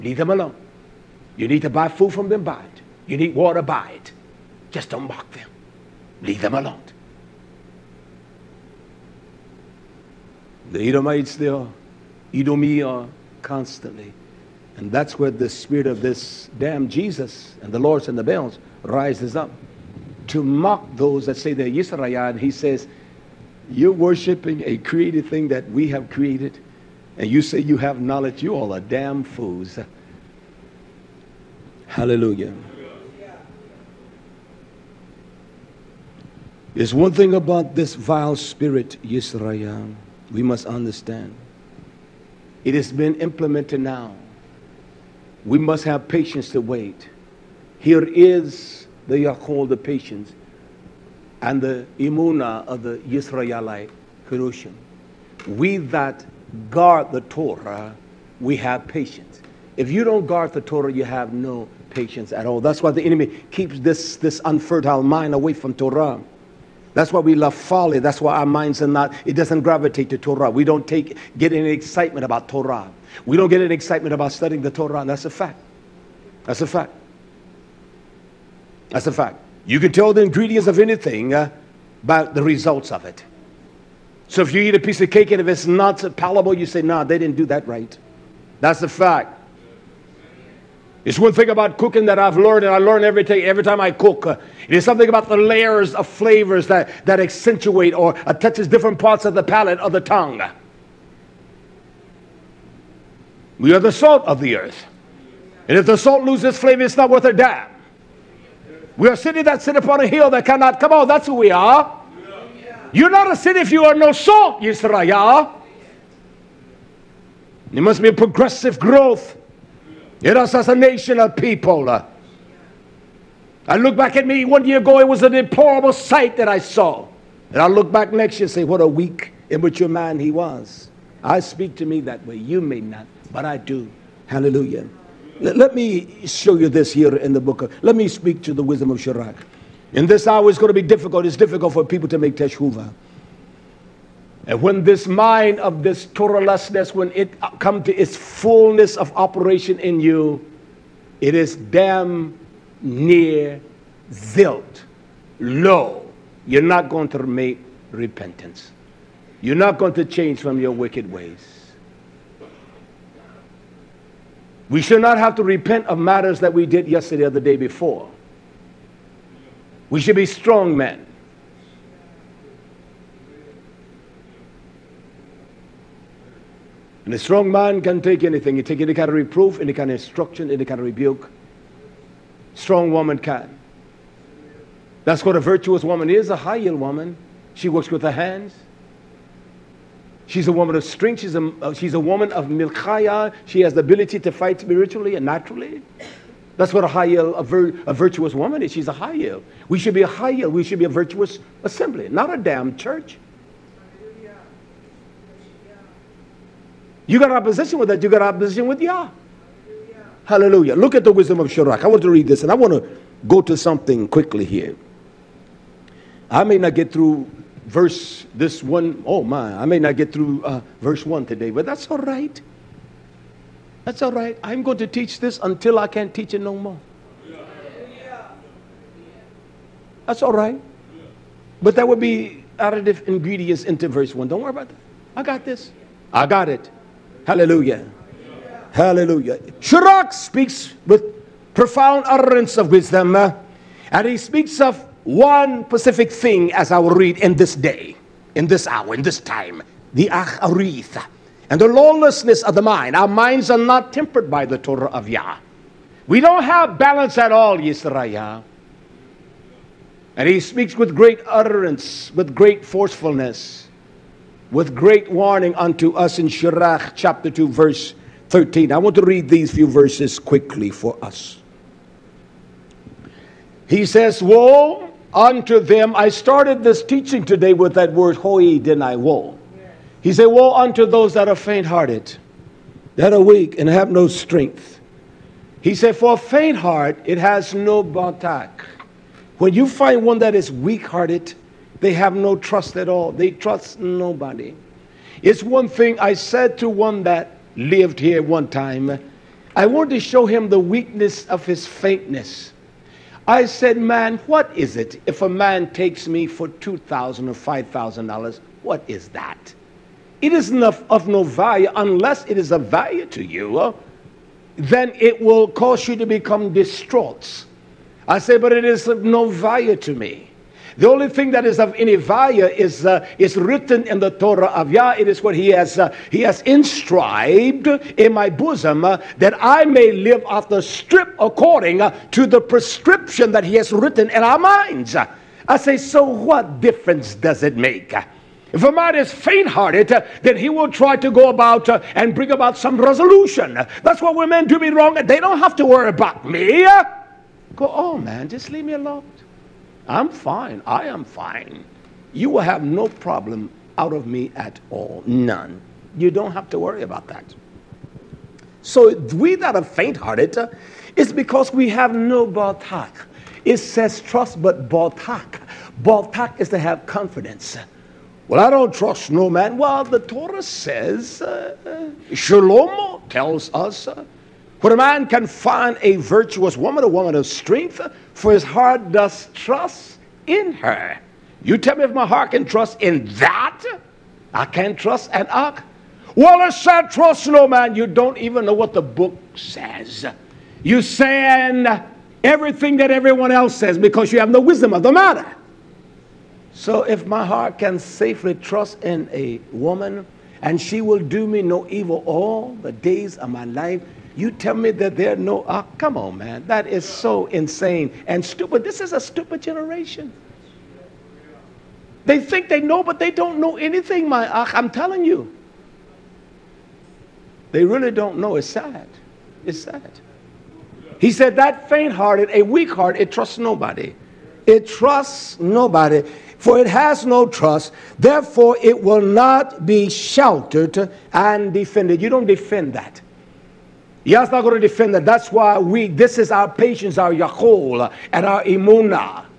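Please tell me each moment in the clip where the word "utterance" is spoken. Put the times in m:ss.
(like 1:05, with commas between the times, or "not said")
4:02, 4:21.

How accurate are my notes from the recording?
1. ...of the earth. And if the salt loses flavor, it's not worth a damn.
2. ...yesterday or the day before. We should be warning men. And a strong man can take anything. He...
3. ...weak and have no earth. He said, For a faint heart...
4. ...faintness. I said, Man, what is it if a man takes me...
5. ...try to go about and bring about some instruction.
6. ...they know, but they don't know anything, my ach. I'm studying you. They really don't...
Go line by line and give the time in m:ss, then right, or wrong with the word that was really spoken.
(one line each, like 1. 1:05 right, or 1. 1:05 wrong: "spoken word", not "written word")
1. 1:44 right
2. 2:46 wrong: "strong", not "warning"
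3. 4:43 wrong: "strength", not "earth"
4. 5:01 right
5. 5:40 wrong: "resolution", not "instruction"
6. 6:52 wrong: "telling", not "studying".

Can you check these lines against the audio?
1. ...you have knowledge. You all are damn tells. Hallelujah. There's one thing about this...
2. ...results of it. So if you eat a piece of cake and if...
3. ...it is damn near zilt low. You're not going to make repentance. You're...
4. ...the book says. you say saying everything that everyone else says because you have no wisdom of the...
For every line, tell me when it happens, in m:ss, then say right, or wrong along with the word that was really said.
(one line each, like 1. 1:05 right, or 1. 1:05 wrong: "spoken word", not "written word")
1. 0:27 wrong: "fools", not "tells"
2. 1:22 right
3. 2:31 right
4. 6:28 right.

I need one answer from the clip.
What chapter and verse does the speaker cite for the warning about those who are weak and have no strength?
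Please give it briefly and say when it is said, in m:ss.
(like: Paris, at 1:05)
Chapter 2, verse 13, at 4:26.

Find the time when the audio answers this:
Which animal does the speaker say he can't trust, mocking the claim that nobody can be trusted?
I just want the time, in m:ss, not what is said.
6:25.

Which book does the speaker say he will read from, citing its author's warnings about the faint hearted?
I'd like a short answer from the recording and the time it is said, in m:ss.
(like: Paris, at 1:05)
Wisdom of Sirach, at 3:31.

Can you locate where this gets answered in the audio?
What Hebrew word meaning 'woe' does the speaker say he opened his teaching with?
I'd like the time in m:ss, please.
4:38.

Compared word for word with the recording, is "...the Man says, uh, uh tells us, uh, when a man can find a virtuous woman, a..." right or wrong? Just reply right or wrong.
wrong.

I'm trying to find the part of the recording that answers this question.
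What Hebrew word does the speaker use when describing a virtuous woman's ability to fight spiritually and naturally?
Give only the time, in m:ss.
3:12.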